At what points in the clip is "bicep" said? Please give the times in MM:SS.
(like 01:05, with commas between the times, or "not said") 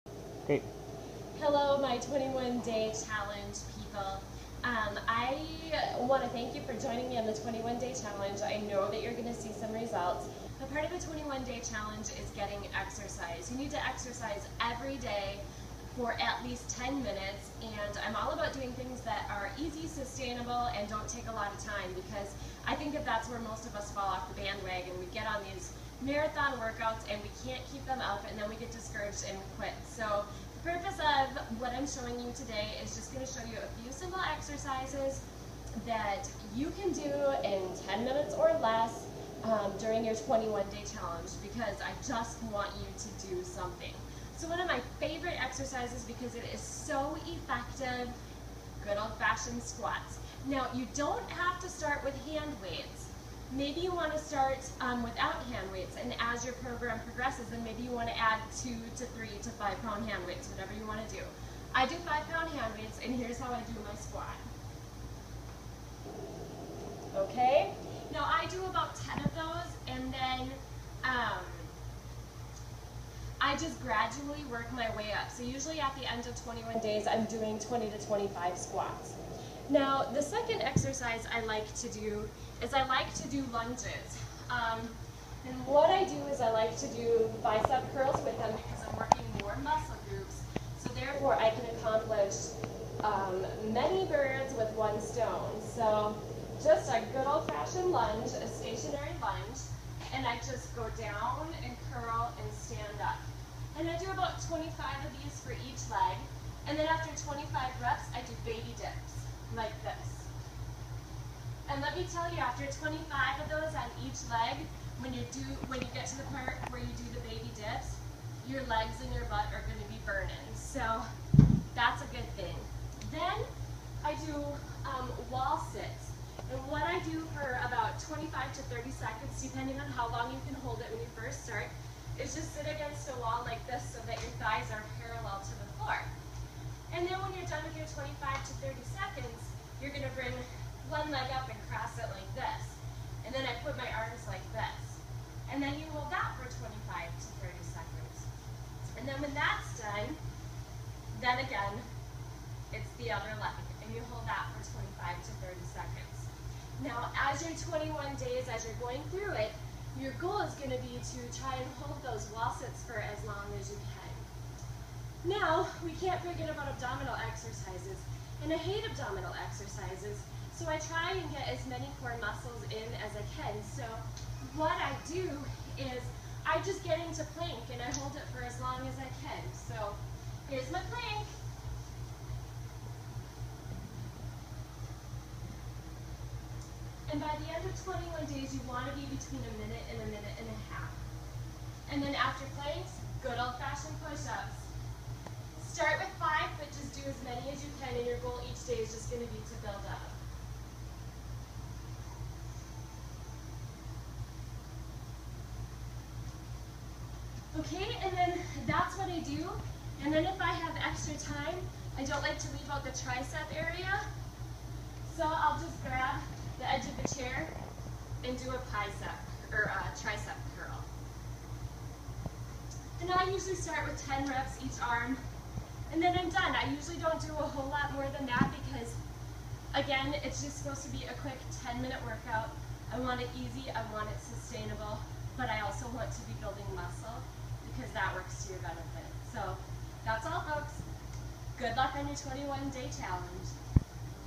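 01:27, 03:38.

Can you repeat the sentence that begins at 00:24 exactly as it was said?
We get on these marathon workouts and we can't keep them up and then we get discouraged and quit.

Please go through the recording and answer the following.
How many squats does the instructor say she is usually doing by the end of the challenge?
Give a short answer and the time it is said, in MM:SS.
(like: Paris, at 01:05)
20 to 25, at 01:17.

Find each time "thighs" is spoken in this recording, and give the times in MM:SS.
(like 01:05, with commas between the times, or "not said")
02:14.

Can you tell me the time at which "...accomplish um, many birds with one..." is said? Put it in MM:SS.
01:31.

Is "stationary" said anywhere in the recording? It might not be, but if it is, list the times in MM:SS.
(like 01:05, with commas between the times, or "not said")
01:38.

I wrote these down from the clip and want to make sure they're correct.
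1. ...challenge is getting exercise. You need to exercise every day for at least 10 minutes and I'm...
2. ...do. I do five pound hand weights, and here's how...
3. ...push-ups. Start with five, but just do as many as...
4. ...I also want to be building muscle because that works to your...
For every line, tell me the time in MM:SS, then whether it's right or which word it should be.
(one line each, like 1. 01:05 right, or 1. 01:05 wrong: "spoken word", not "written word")
1. 00:11 right
2. 01:01 right
3. 03:14 right
4. 03:55 right.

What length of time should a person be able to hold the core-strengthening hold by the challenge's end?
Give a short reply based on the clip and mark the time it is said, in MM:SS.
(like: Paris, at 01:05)
1 to 1.5 minutes, at 03:09.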